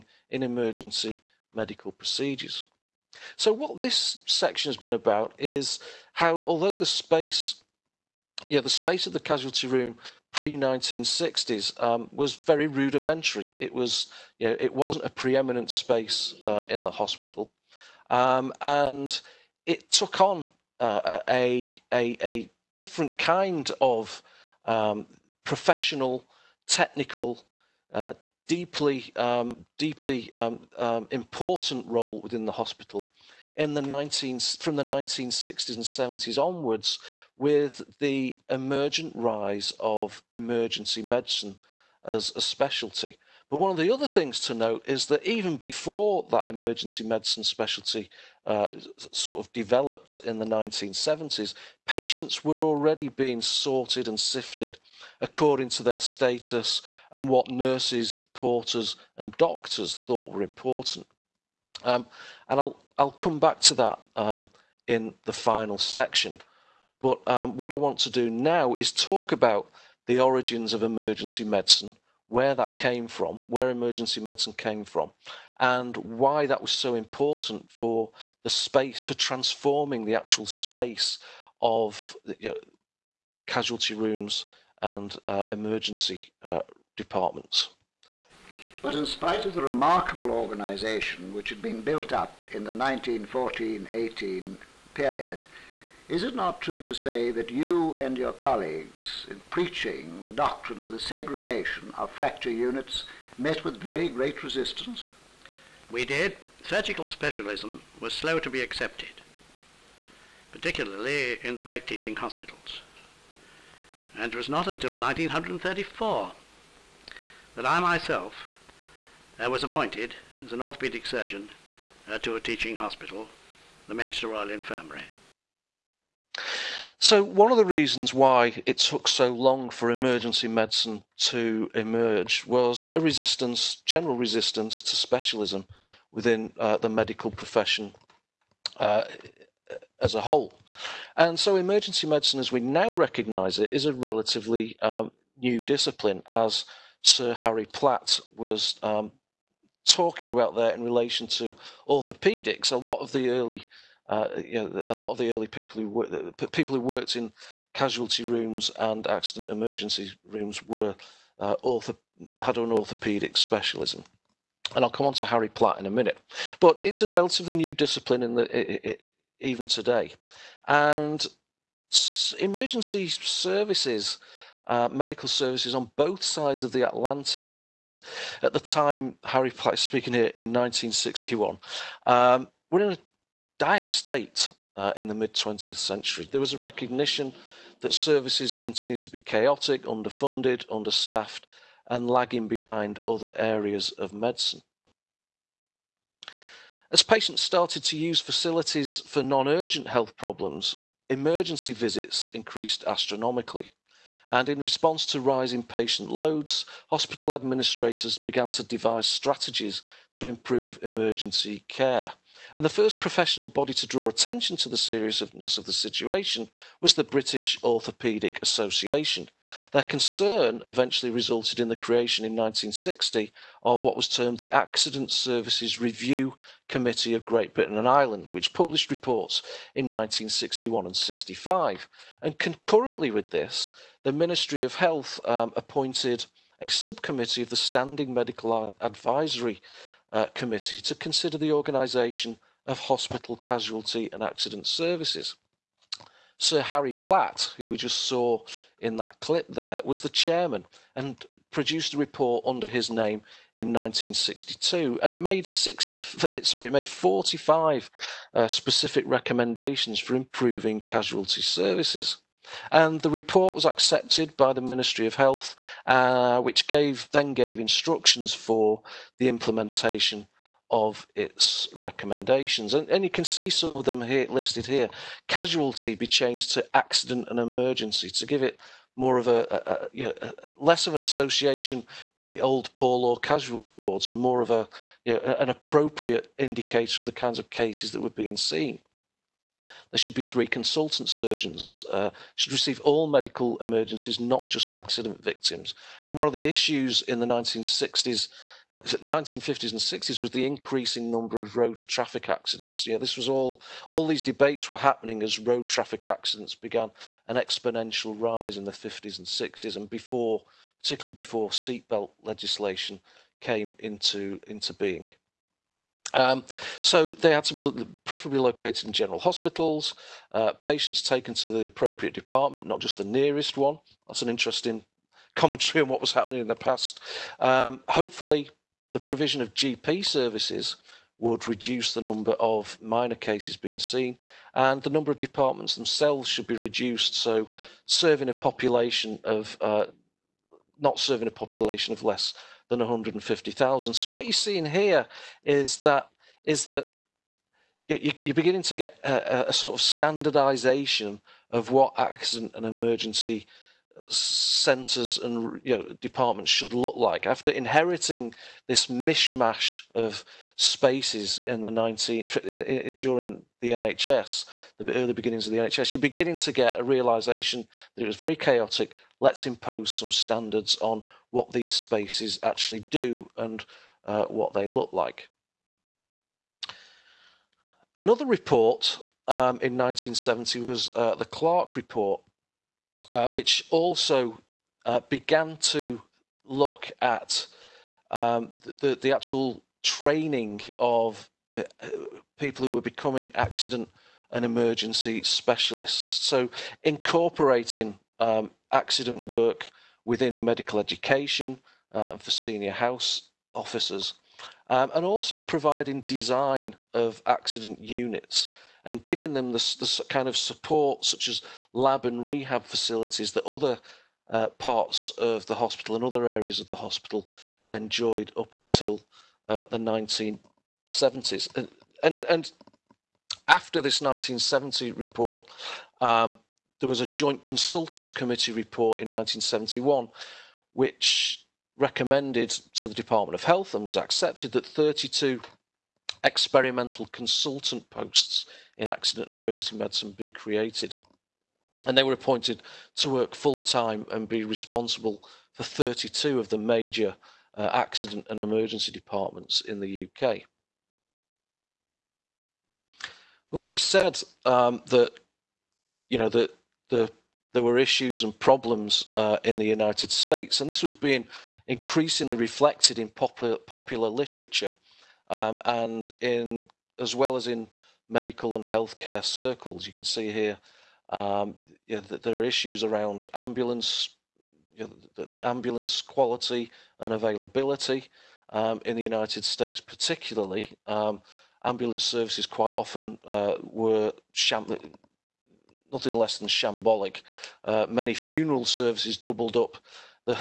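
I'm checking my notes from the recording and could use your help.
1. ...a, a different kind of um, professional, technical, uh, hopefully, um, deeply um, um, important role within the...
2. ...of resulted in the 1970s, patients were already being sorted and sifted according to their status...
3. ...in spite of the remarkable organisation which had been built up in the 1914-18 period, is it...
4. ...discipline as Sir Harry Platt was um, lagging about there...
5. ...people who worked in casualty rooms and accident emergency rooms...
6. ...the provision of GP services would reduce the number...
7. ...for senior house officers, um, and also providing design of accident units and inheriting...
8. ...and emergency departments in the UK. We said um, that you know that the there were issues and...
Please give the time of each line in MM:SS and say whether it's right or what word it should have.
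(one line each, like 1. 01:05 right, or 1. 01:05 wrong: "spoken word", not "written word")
1. 00:21 wrong: "deeply", not "hopefully"
2. 00:49 wrong: "developed", not "resulted"
3. 01:28 right
4. 02:25 wrong: "talking", not "lagging"
5. 02:36 right
6. 05:28 right
7. 06:42 wrong: "giving", not "inheriting"
8. 07:28 right.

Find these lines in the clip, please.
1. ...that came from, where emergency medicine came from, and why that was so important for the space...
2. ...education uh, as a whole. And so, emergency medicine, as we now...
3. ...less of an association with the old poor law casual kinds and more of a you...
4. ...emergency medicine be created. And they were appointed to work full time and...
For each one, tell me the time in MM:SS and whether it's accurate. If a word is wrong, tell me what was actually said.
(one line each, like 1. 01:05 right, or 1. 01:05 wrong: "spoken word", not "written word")
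1. 01:12 right
2. 02:17 wrong: "profession", not "education"
3. 04:40 wrong: "wards", not "kinds"
4. 07:19 right.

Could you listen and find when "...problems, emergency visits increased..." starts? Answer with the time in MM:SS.
03:20.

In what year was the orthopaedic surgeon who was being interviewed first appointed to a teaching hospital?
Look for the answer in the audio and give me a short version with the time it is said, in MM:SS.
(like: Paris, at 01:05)
1934, at 01:54.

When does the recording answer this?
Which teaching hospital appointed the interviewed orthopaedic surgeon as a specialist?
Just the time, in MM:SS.
02:03.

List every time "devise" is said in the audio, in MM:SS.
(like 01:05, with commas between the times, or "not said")
03:28.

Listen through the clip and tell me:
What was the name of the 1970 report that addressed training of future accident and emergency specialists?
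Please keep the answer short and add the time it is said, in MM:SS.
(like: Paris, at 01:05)
Clark report, at 06:21.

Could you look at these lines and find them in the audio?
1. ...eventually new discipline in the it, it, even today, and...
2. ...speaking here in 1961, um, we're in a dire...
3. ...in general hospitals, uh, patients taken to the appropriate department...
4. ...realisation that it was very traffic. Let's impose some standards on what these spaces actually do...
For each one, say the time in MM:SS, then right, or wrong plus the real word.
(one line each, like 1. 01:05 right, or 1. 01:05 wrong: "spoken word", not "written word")
1. 02:47 wrong: "relatively", not "eventually"
2. 02:59 right
3. 05:18 right
4. 06:06 wrong: "chaotic", not "traffic".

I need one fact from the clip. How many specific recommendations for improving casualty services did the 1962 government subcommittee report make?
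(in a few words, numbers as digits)
45.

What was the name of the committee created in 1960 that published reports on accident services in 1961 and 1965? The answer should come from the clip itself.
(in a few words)
Accident Services Review Committee.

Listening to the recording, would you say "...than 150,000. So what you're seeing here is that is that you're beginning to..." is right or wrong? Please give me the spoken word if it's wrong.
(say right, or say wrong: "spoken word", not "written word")
right.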